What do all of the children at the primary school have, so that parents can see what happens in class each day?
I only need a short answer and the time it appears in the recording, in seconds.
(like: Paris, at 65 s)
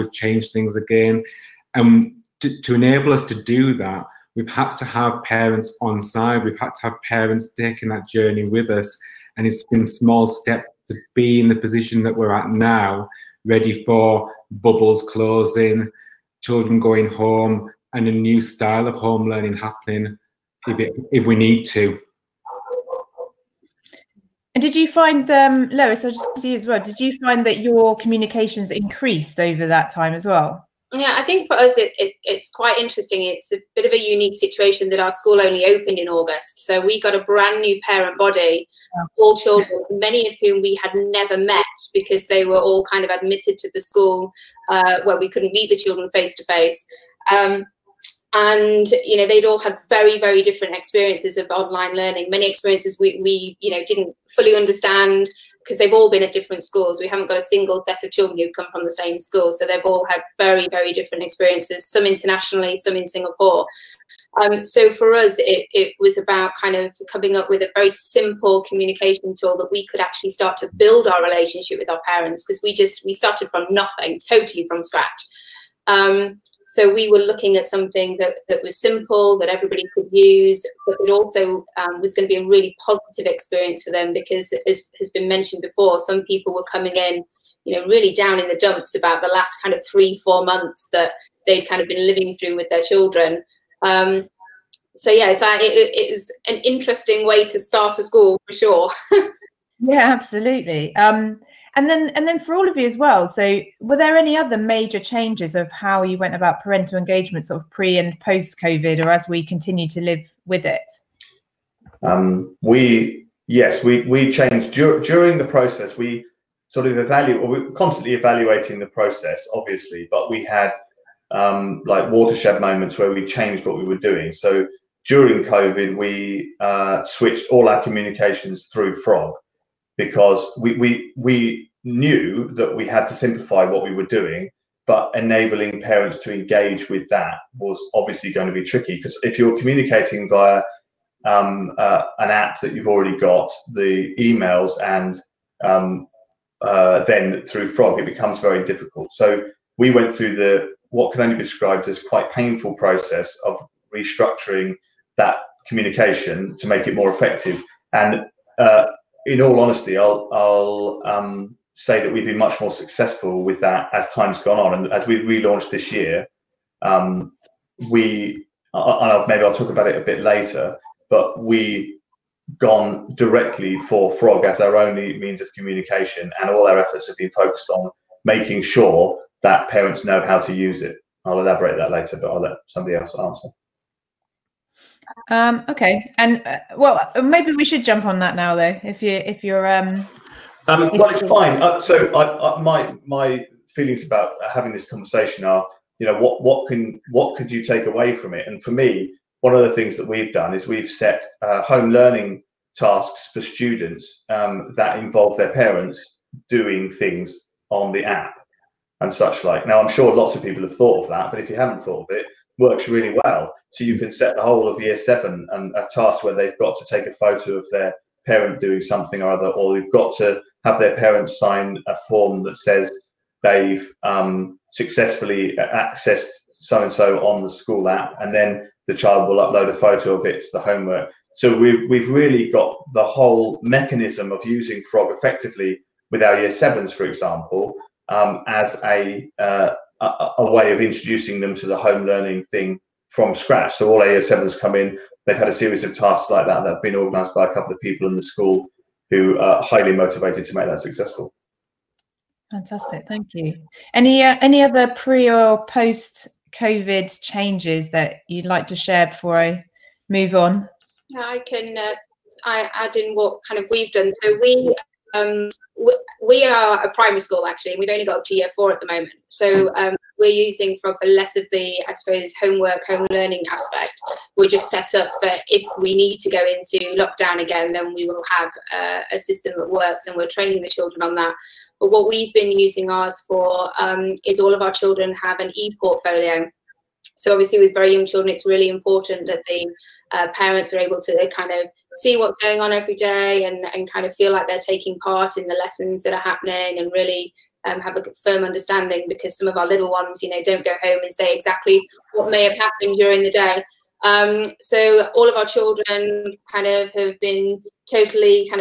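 An e-portfolio, at 285 s.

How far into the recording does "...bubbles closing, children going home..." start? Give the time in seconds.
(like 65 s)
14 s.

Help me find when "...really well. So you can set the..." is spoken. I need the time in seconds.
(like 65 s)
212 s.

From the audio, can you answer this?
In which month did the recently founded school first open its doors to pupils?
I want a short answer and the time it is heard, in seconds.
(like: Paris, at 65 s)
August, at 36 s.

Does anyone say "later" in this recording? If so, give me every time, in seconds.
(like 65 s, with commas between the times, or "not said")
170 s, 181 s.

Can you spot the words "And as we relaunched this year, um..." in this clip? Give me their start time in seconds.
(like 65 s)
164 s.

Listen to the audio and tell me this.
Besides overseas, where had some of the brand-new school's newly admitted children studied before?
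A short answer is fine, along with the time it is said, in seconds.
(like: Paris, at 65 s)
Singapore, at 63 s.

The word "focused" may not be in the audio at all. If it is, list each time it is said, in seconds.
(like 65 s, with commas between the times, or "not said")
177 s.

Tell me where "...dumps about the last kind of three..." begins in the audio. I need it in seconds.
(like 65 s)
88 s.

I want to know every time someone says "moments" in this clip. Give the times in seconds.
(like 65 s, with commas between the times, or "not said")
122 s, 268 s.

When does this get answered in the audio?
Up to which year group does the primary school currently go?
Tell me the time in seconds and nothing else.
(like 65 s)
268 s.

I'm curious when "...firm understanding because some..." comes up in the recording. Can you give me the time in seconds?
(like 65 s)
298 s.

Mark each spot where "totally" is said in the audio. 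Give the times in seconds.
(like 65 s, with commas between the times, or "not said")
74 s, 307 s.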